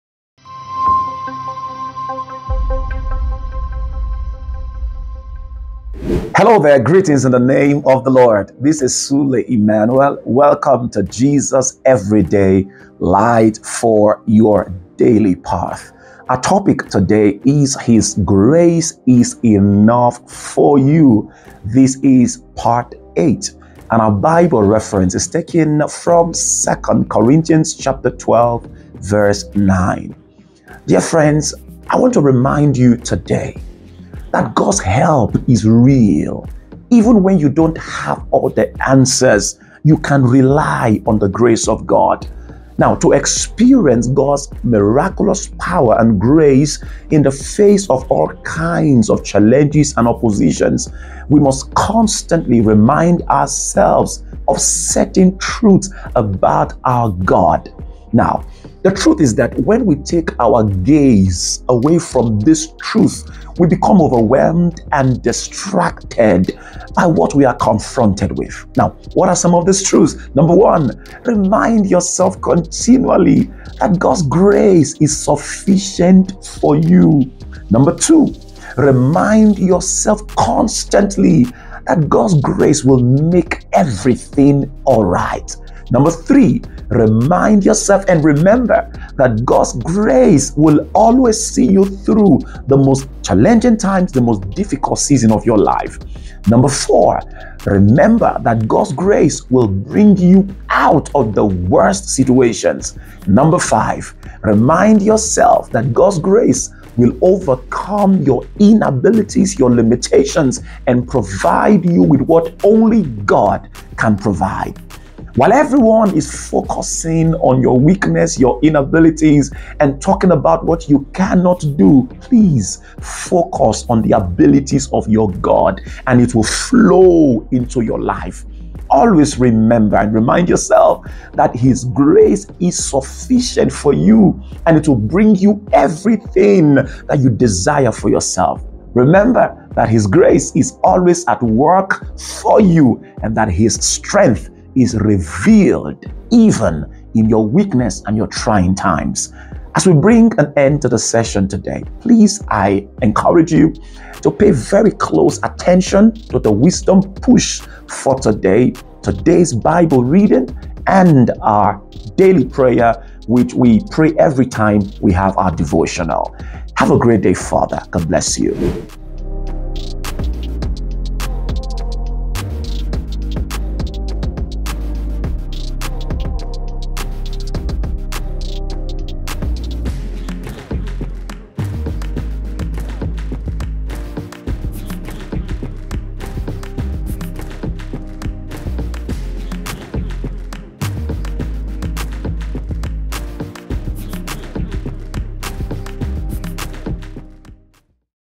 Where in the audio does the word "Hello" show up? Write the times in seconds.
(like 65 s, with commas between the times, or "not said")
6 s.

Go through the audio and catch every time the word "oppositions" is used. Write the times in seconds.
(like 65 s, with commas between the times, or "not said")
50 s.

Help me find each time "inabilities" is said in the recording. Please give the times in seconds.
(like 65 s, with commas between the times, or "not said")
108 s, 118 s.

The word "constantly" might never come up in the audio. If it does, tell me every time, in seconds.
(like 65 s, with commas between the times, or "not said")
51 s, 80 s.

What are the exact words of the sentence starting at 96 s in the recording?
Number four, remember that God's grace will bring you out of the worst situations.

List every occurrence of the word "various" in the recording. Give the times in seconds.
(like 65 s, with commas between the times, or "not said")
not said.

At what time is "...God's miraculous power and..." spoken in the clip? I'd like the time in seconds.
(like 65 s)
44 s.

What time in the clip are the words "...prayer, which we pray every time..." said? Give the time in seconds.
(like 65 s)
162 s.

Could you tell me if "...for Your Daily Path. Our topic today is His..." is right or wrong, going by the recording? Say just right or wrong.
right.